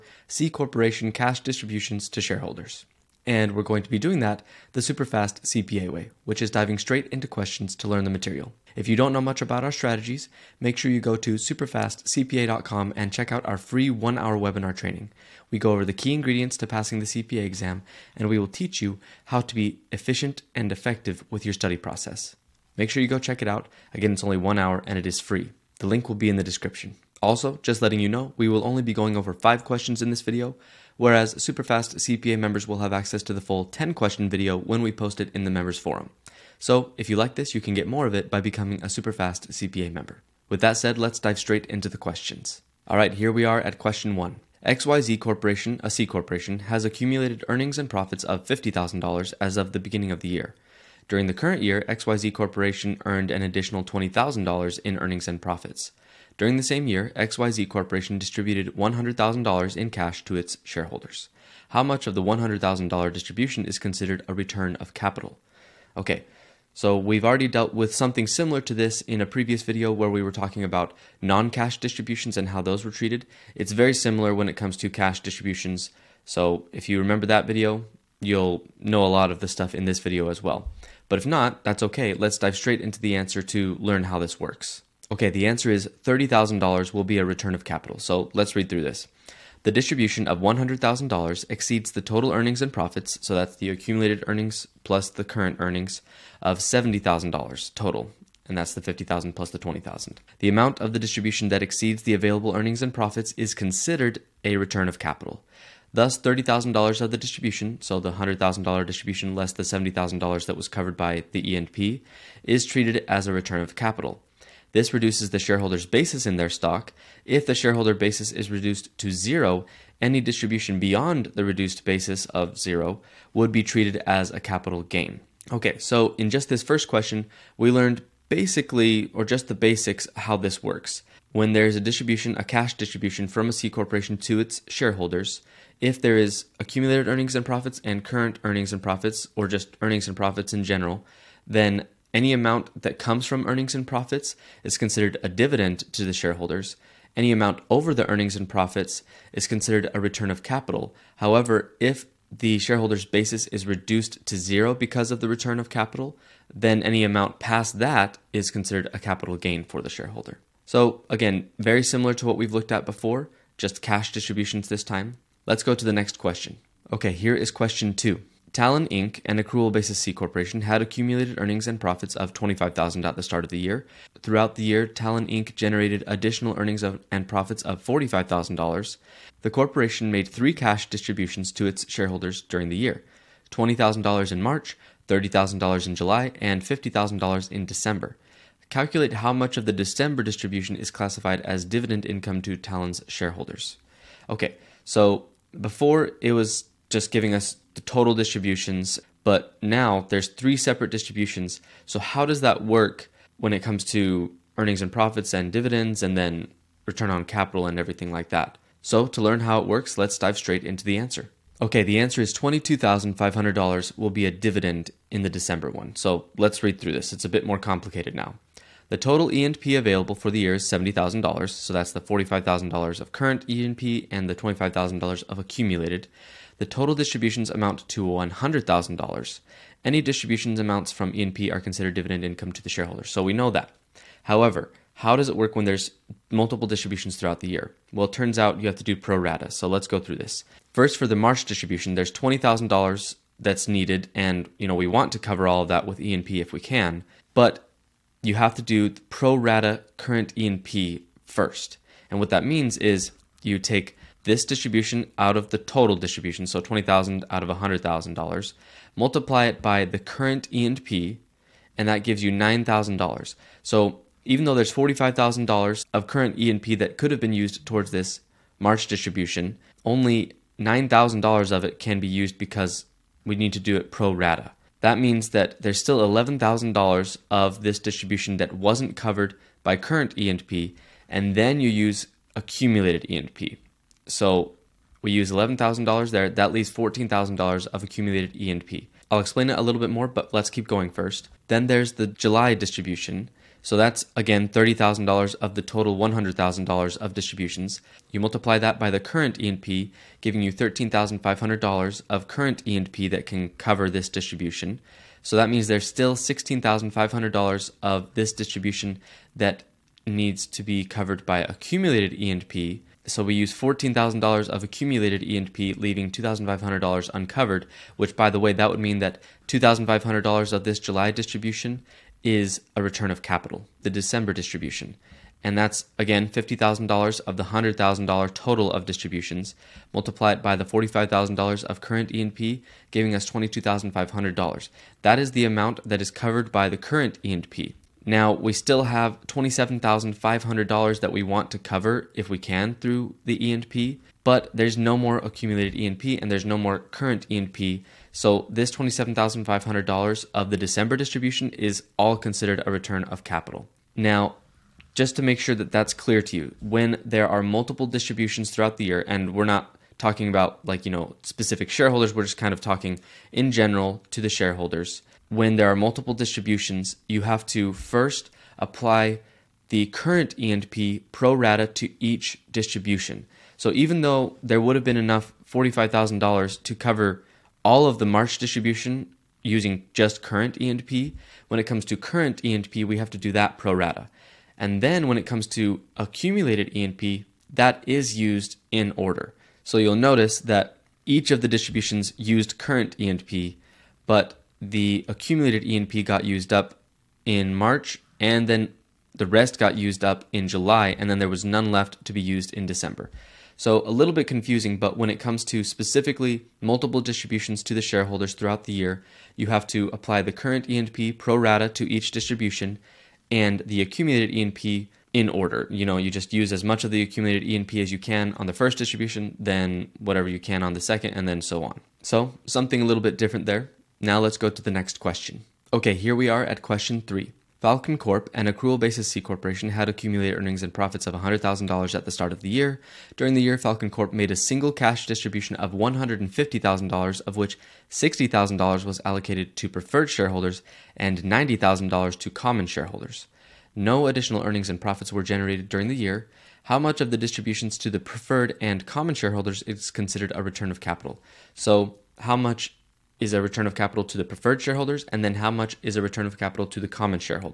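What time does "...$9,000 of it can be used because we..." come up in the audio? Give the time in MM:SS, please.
04:30.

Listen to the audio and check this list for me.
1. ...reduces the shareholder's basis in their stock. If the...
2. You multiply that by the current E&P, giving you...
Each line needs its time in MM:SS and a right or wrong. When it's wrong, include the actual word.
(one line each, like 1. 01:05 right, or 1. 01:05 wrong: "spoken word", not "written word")
1. 01:54 right
2. 04:58 right.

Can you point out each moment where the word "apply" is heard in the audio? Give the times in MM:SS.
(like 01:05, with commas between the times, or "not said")
06:08, 06:49.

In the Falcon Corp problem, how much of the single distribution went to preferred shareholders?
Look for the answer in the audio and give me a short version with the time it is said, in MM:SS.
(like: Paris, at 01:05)
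$60,000, at 07:17.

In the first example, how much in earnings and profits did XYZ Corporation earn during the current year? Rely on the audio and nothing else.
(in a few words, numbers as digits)
$20,000.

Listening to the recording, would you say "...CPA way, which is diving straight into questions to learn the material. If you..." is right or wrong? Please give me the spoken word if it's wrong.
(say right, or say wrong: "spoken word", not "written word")
right.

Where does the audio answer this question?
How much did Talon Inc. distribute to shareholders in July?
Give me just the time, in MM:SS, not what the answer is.
03:05.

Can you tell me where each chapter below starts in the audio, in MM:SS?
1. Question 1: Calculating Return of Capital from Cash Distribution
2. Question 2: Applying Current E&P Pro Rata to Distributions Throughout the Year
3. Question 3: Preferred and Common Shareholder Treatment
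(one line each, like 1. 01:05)
1. 00:41
2. 02:45
3. 07:04.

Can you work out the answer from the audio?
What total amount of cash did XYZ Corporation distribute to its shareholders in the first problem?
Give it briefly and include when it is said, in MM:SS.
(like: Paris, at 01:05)
$100,000, at 00:58.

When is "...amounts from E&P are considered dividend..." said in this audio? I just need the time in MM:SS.
03:50.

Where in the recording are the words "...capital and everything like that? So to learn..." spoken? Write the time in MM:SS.
03:27.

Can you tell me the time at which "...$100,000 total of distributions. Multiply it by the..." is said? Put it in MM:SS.
05:27.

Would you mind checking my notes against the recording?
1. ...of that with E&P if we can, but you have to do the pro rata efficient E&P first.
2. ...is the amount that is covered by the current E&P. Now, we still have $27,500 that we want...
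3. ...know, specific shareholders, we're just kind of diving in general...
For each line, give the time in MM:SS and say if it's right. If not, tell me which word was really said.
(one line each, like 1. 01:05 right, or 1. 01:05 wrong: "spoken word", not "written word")
1. 04:05 wrong: "current", not "efficient"
2. 05:35 right
3. 06:00 wrong: "talking", not "diving".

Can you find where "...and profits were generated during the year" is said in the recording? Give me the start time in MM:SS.
07:24.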